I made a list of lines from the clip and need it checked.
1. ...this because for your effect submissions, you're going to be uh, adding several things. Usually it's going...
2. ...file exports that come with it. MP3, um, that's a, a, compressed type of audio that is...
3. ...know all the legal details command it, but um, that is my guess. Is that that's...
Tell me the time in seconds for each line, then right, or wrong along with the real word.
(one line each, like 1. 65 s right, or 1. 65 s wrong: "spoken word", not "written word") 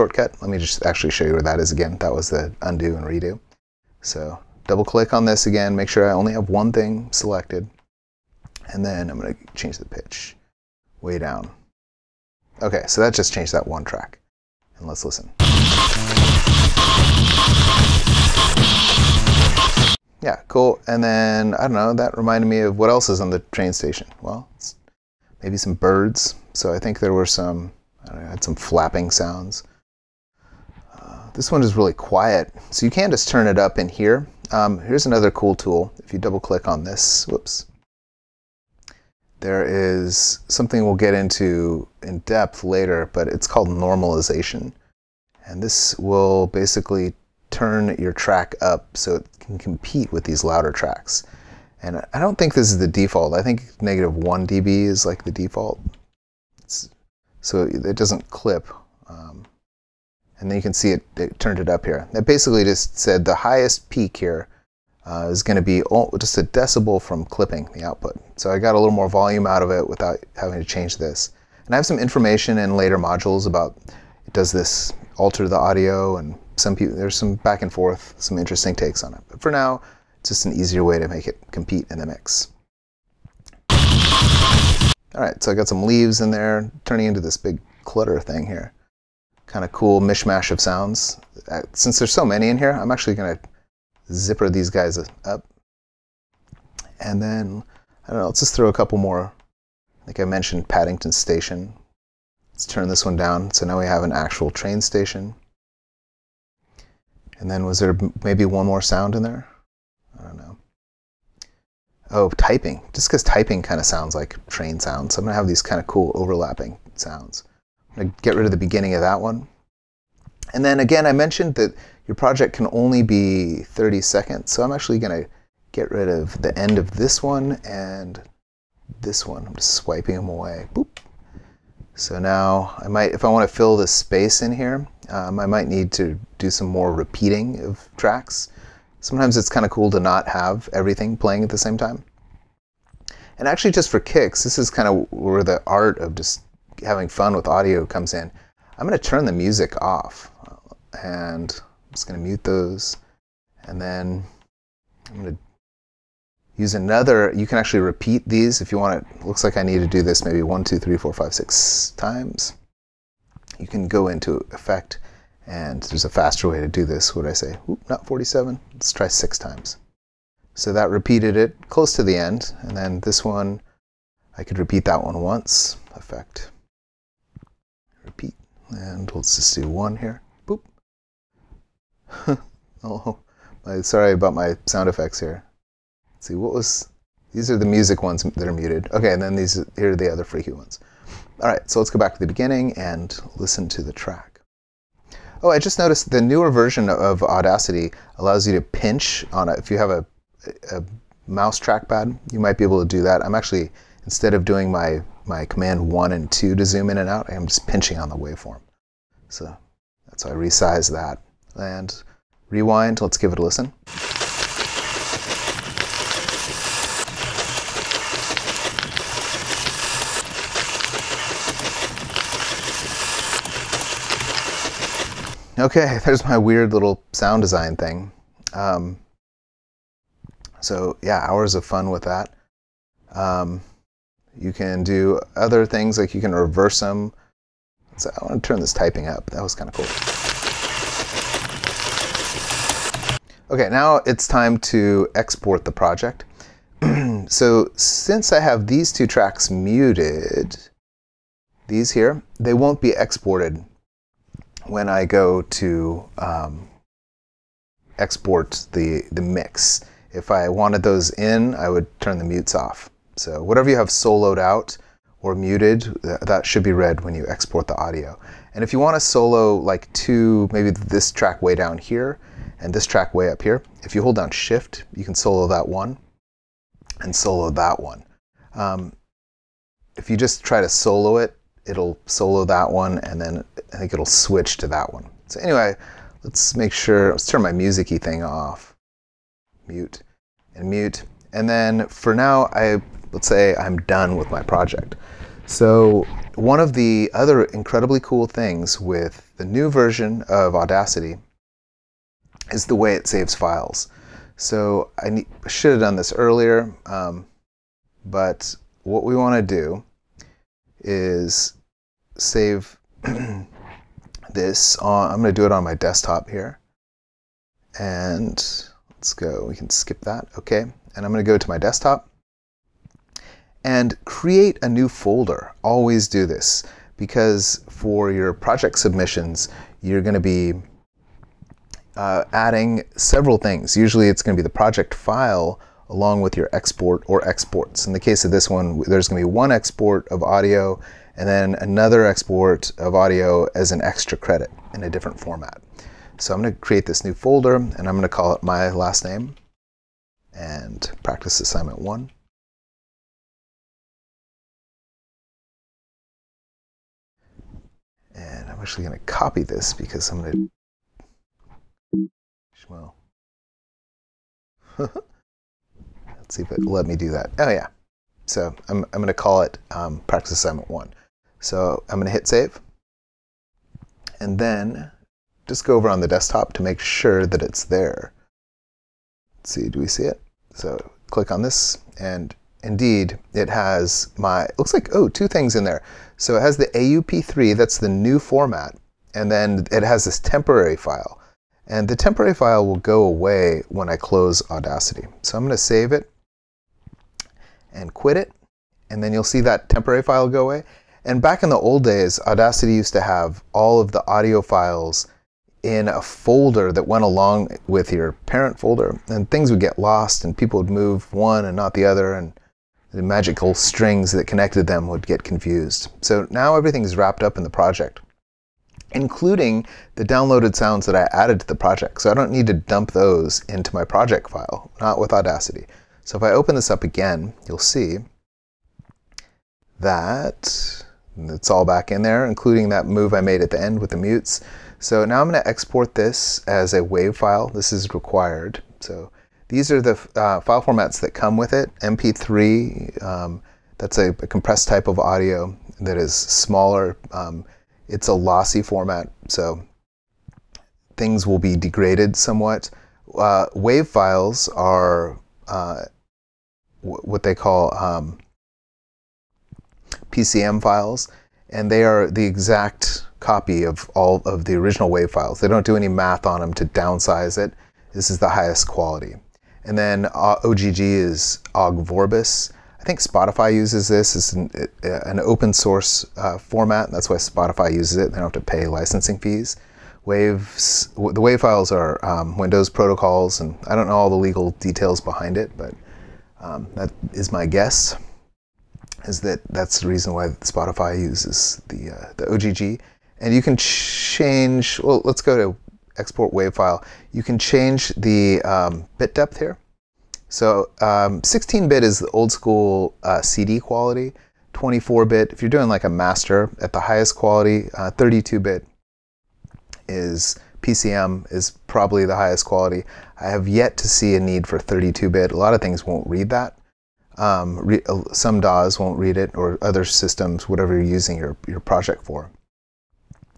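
1. 326 s wrong: "project", not "effect"
2. 440 s wrong: "formats", not "exports"
3. 483 s wrong: "behind", not "command".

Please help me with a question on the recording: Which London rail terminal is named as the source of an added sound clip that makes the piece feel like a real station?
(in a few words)
Paddington Station.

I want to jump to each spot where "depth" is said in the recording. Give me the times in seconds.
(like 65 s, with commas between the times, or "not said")
42 s, 499 s.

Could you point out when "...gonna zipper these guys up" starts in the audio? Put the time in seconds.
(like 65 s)
93 s.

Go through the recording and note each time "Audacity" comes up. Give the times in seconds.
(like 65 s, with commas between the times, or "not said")
197 s, 300 s, 394 s, 402 s, 425 s.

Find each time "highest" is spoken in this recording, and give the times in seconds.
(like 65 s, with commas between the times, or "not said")
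63 s, 468 s, 506 s, 512 s.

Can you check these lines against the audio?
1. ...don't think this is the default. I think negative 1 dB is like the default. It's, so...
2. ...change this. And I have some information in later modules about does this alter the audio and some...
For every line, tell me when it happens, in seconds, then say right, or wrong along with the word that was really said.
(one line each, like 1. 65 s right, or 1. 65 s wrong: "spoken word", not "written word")
1. 52 s right
2. 70 s right.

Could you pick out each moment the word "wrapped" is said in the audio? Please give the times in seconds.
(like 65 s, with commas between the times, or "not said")
416 s.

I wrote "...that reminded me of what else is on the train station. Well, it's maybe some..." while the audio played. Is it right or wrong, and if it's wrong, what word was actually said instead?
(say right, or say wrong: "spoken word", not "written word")
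right.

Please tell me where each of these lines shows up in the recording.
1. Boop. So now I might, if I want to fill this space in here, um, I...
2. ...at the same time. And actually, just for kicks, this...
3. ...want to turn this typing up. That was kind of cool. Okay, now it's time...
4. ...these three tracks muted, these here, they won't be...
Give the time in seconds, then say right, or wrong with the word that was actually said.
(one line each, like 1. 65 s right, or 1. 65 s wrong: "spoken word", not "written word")
1. 130 s right
2. 141 s right
3. 238 s right
4. 248 s wrong: "two", not "three".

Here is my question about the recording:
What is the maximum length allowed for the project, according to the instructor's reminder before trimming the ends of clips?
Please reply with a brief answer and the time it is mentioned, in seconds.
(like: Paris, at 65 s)
30 seconds, at 123 s.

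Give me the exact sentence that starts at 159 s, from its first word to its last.
Looks like I need to do this maybe one, two, three, four, five, six times.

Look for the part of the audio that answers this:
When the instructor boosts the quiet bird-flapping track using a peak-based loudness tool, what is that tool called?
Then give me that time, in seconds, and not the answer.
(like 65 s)
43 s.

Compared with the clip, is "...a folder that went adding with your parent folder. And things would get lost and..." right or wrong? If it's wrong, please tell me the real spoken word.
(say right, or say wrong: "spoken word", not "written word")
wrong: "along", not "adding".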